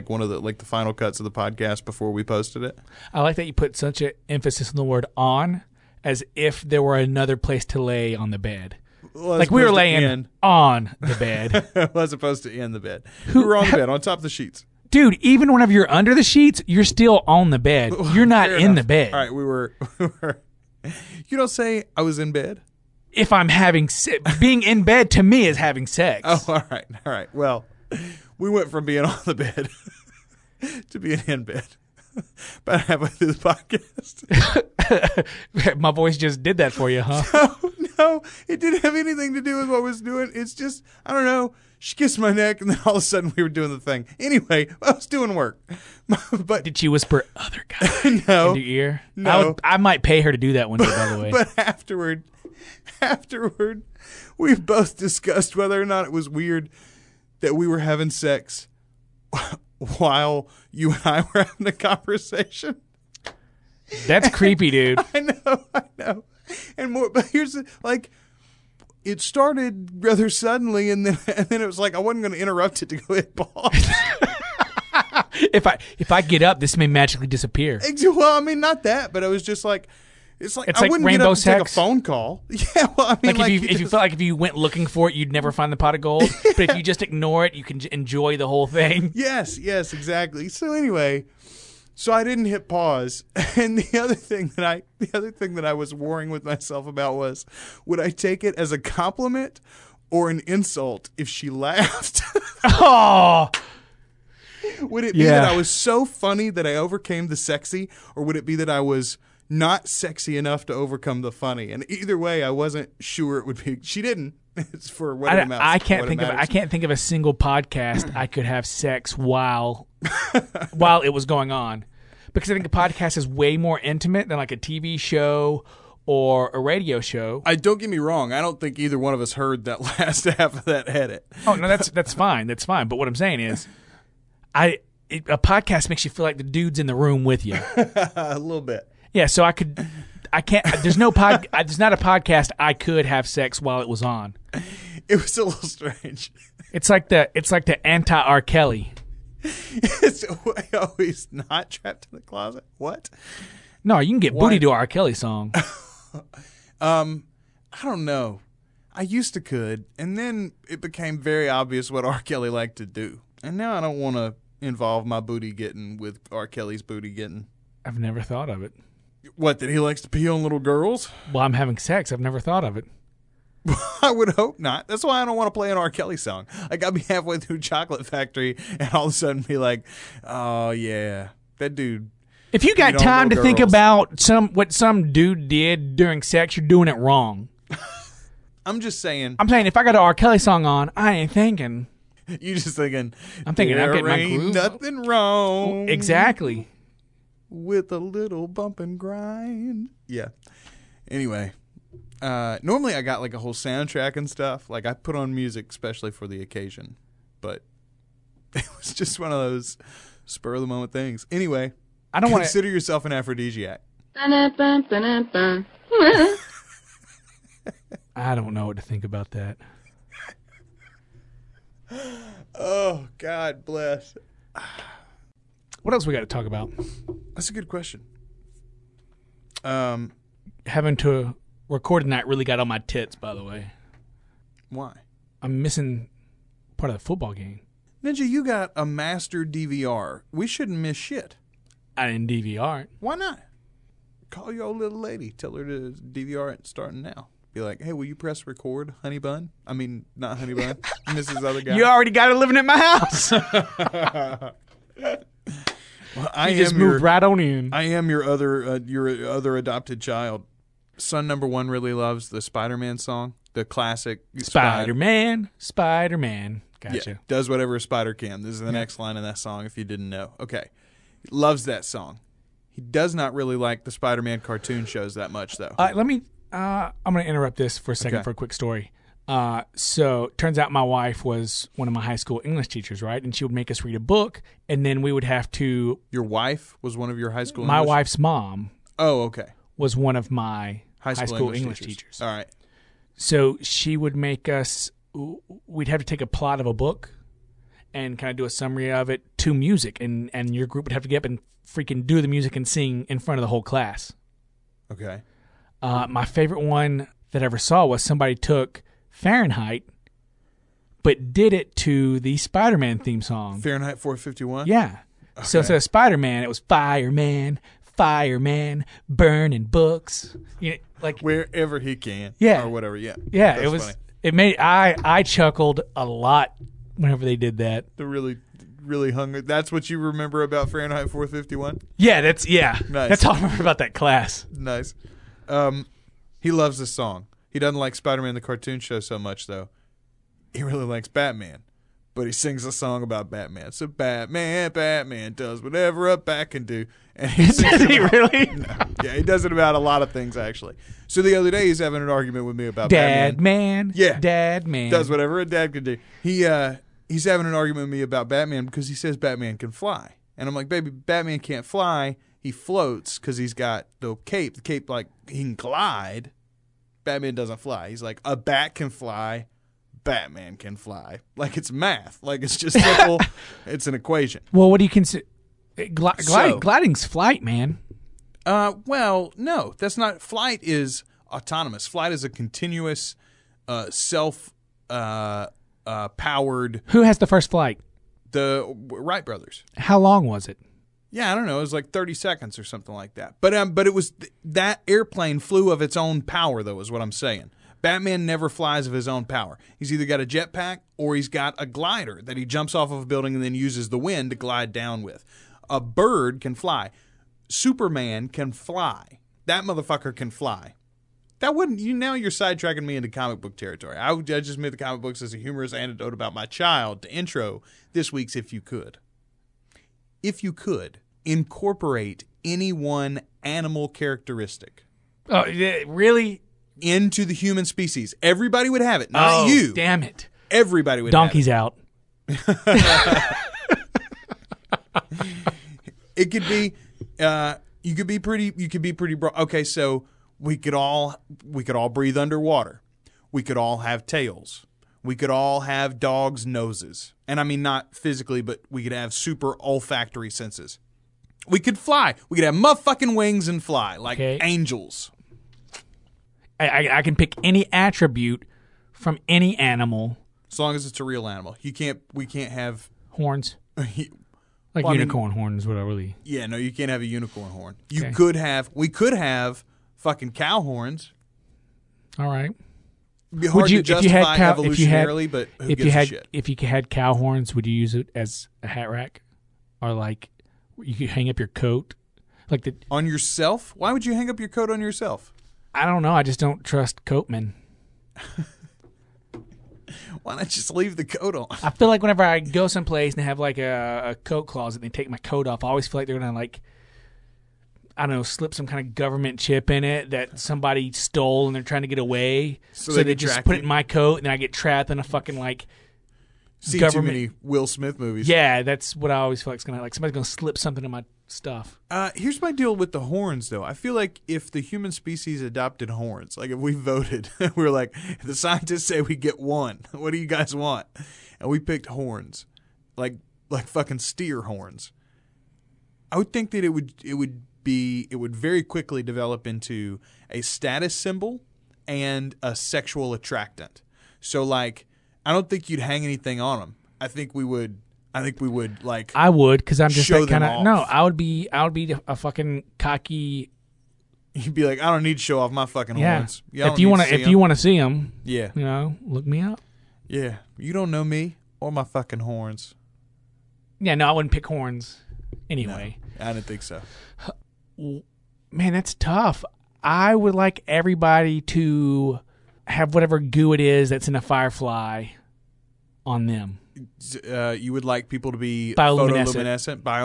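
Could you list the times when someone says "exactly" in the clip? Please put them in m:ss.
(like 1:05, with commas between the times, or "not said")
1:29, 3:15.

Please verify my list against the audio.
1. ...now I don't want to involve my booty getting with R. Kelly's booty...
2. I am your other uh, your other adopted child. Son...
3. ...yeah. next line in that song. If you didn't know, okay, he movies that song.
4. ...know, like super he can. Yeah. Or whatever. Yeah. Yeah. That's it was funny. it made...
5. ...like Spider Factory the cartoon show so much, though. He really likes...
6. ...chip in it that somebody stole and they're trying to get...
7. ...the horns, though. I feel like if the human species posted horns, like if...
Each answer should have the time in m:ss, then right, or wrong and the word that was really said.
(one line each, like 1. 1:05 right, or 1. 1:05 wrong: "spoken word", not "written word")
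1. 2:43 right
2. 4:17 right
3. 4:28 wrong: "loves", not "movies"
4. 5:20 wrong: "wherever", not "super"
5. 5:37 wrong: "Man", not "Factory"
6. 8:19 right
7. 8:32 wrong: "adopted", not "posted".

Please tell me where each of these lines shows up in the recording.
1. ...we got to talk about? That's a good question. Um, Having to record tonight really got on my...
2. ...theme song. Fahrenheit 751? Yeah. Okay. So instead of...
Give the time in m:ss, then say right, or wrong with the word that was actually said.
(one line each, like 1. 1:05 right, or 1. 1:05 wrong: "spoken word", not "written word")
1. 3:46 right
2. 5:12 wrong: "451", not "751".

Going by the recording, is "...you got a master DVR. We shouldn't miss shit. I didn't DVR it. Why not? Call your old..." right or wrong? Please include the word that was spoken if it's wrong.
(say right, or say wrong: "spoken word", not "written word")
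right.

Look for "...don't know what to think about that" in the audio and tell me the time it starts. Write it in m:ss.
3:38.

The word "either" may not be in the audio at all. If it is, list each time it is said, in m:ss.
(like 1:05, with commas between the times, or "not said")
1:51, 2:08, 6:39.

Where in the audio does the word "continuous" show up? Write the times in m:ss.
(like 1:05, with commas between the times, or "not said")
6:22.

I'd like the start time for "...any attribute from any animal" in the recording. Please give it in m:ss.
7:37.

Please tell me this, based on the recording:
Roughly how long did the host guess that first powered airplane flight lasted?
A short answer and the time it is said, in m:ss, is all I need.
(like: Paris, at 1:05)
30 seconds, at 6:31.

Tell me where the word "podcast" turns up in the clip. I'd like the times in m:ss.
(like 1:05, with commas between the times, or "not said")
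0:01, 0:33, 1:57, 2:02, 2:15, 2:21.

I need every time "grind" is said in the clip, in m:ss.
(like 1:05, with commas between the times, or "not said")
3:18.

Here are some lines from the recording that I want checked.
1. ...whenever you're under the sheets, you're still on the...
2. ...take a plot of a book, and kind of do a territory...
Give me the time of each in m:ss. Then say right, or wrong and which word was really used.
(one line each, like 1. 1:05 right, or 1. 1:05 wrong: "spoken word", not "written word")
1. 0:15 right
2. 4:56 wrong: "summary", not "territory".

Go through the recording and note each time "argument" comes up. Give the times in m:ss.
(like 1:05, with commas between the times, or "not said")
5:52, 5:57.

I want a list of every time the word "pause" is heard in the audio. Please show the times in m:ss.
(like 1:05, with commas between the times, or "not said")
1:13, 1:32.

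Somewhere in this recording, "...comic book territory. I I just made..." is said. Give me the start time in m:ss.
6:53.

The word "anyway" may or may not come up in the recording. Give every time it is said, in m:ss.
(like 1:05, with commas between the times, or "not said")
0:44, 1:30, 3:21, 3:31, 9:15.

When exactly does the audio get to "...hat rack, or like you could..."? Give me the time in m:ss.
7:58.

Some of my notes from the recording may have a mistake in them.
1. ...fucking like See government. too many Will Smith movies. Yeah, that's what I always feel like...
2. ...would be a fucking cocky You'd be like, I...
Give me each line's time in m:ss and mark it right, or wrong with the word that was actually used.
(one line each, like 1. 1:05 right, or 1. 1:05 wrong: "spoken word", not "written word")
1. 8:25 right
2. 9:01 right.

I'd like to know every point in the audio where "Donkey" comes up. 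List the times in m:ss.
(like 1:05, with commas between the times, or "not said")
7:11.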